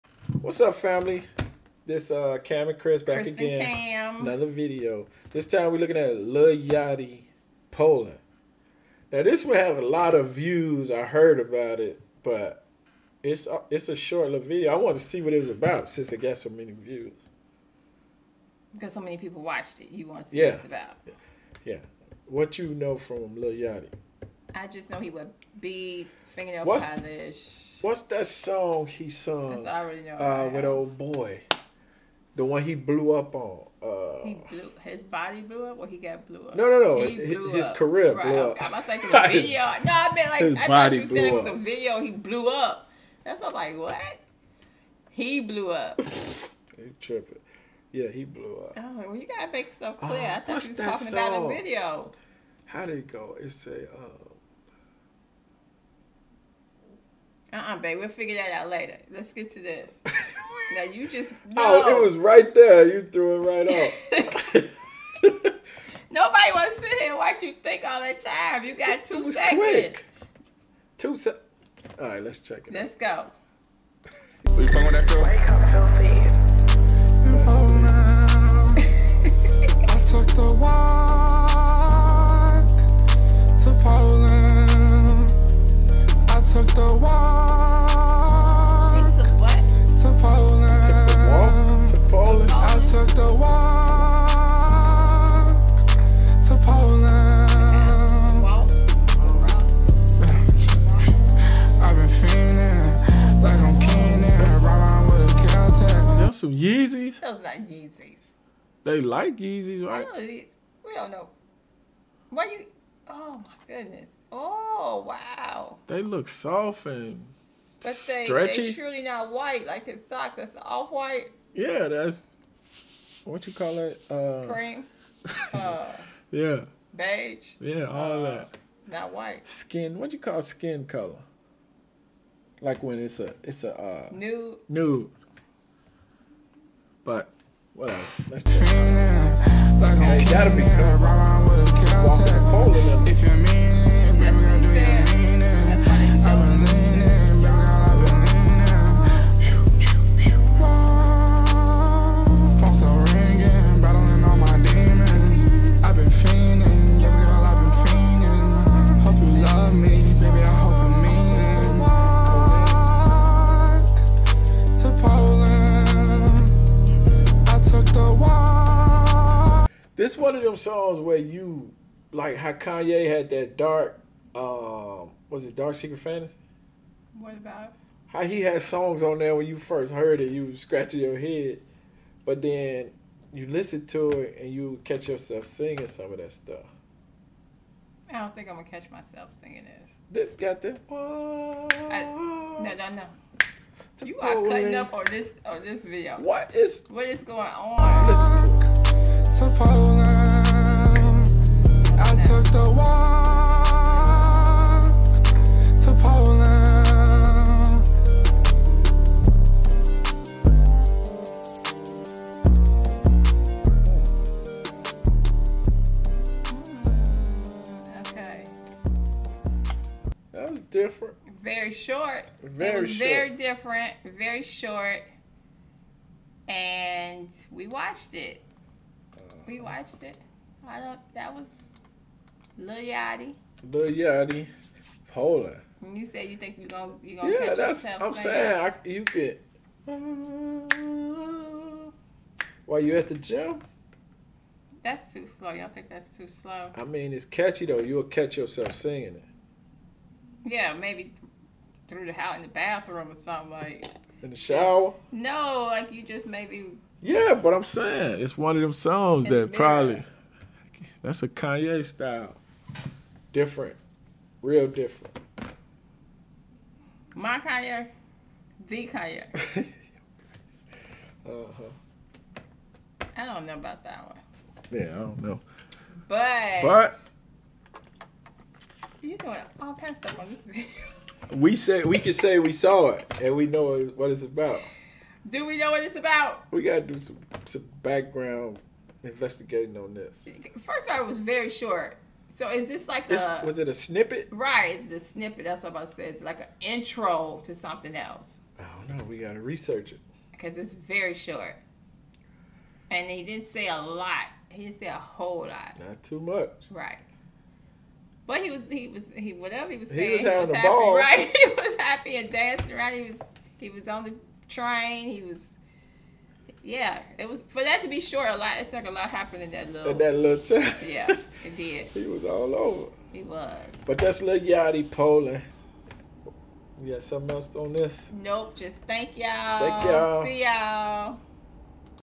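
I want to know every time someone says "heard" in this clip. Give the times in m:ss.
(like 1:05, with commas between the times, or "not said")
0:11, 2:59.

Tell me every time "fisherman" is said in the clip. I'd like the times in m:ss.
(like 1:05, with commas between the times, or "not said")
not said.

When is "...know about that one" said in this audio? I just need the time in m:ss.
4:33.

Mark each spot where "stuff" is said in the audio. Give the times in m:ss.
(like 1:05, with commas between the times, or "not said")
0:49, 3:06, 4:39.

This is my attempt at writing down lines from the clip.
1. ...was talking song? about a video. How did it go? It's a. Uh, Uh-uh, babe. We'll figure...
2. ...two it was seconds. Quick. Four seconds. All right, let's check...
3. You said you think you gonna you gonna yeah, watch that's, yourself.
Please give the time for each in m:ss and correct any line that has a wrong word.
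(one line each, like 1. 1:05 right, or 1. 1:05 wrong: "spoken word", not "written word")
1. 0:50 right
2. 1:09 wrong: "Two", not "Four"
3. 3:55 wrong: "catch", not "watch".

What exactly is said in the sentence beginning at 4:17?
Yeah, but I'm saying it's one of them songs that the probably.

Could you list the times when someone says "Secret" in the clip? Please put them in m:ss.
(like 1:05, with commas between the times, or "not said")
2:55.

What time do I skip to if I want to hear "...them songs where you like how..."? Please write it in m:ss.
2:50.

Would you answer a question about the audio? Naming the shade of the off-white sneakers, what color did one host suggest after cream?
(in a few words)
Beige.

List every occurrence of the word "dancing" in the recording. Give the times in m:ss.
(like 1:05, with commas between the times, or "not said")
5:12.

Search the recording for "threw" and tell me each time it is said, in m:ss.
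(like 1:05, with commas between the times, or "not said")
1:03.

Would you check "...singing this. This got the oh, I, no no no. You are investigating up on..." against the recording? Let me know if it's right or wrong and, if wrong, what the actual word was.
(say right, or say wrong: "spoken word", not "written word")
wrong: "cutting", not "investigating".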